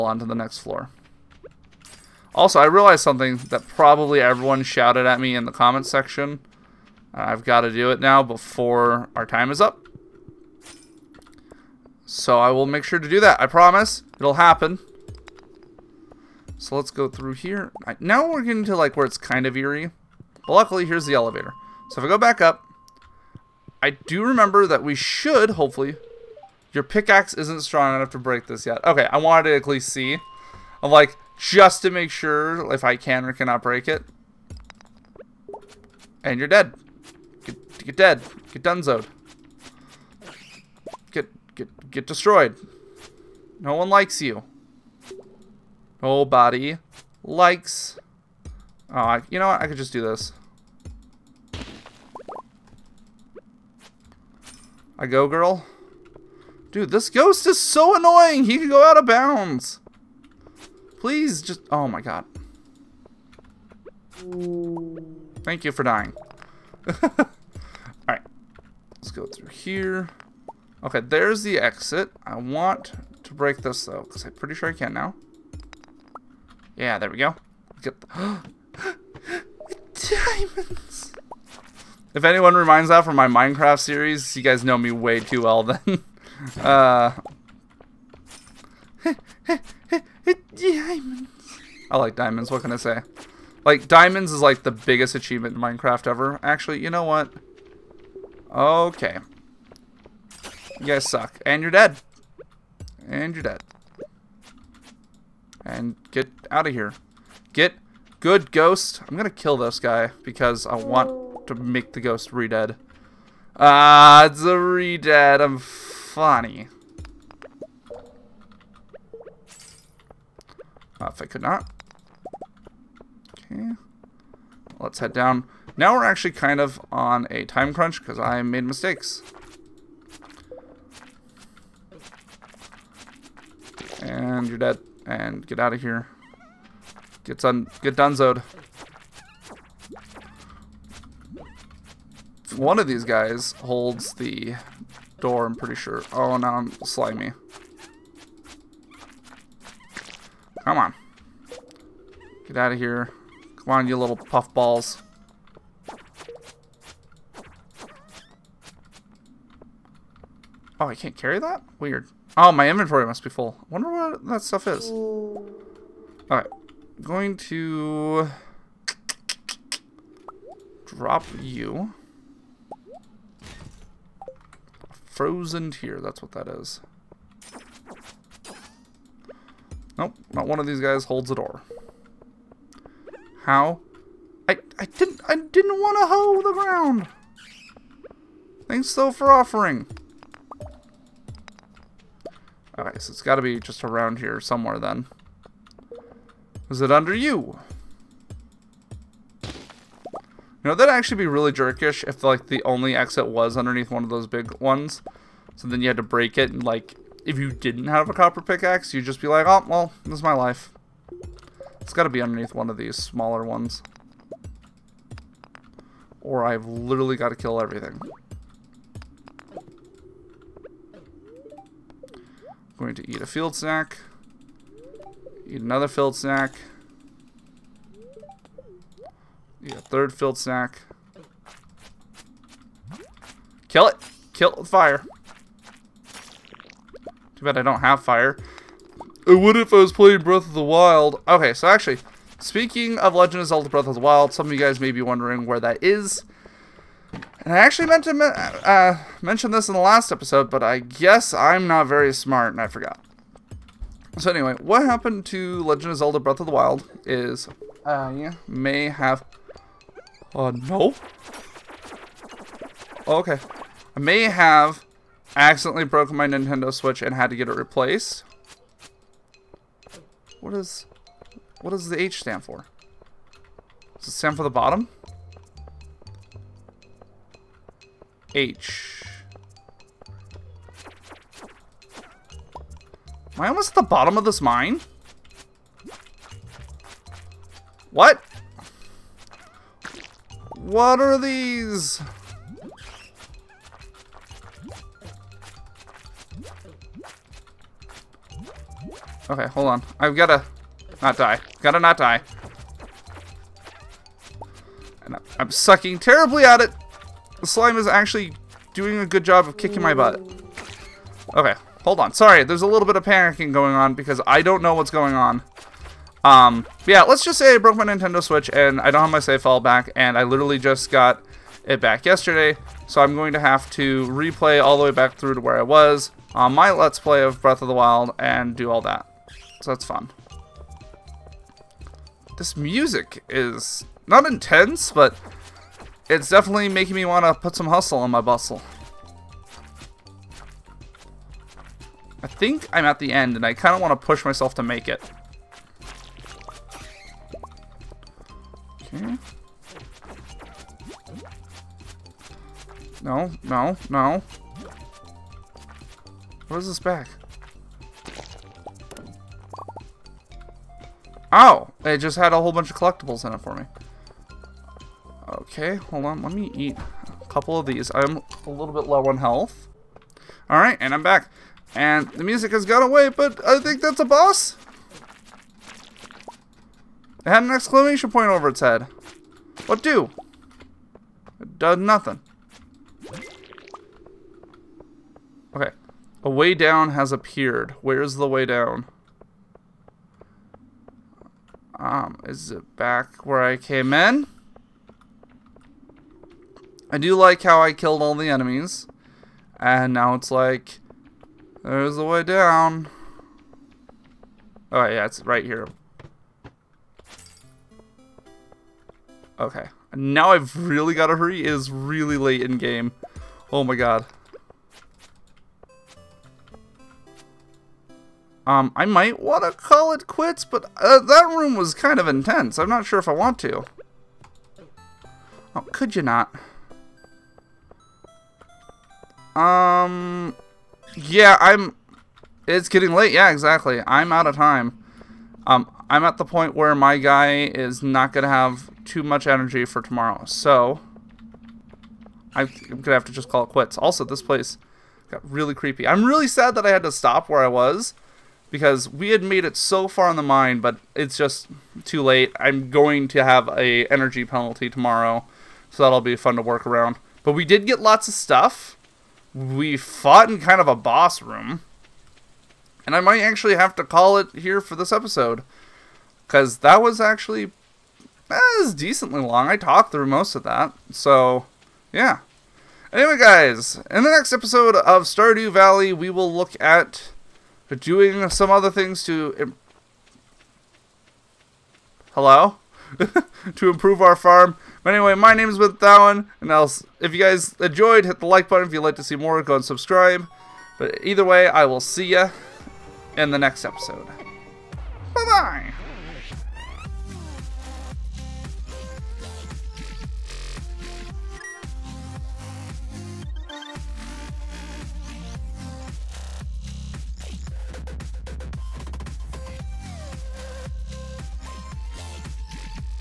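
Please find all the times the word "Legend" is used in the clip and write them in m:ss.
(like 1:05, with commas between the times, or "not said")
4:03, 4:15.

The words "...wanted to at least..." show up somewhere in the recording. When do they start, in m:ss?
0:29.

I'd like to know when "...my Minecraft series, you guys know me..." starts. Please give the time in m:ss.
1:23.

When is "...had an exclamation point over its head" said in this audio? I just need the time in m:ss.
6:17.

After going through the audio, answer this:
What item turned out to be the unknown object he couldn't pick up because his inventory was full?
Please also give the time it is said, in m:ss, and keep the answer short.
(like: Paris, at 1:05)
Frozen Tear, at 2:55.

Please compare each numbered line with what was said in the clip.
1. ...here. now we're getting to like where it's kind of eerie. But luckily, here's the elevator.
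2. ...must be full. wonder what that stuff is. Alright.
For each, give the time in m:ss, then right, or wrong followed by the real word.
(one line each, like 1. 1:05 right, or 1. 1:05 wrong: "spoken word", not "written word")
1. 0:17 right
2. 2:43 right.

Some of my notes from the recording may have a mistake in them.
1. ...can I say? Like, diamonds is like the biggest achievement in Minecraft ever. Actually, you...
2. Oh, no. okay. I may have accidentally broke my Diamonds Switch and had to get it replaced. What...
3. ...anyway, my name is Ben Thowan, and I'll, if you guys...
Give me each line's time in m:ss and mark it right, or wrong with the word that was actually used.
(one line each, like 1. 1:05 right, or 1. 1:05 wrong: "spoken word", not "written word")
1. 1:32 right
2. 4:20 wrong: "Nintendo", not "Diamonds"
3. 8:04 right.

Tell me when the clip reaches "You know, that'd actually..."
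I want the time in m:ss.
3:19.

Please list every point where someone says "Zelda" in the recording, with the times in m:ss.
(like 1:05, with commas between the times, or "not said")
4:03, 4:15.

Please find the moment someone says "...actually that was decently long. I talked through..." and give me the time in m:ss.
7:47.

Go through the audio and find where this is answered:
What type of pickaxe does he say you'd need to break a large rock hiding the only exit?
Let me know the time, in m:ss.
3:28.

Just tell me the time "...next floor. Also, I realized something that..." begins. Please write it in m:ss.
0:00.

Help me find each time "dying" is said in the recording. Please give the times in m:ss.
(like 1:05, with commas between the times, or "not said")
1:05.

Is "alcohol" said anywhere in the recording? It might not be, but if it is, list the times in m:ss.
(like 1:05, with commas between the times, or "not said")
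not said.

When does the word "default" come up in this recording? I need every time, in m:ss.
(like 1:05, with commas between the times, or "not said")
not said.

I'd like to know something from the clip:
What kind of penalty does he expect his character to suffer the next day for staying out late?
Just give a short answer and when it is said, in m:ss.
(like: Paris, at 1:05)
energy penalty, at 7:33.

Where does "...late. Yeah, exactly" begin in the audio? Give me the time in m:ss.
7:12.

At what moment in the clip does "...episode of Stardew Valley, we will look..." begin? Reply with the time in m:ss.
7:54.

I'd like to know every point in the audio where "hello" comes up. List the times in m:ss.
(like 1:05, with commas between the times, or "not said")
8:02.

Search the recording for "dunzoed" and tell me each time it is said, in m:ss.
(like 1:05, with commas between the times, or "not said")
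0:38, 2:17.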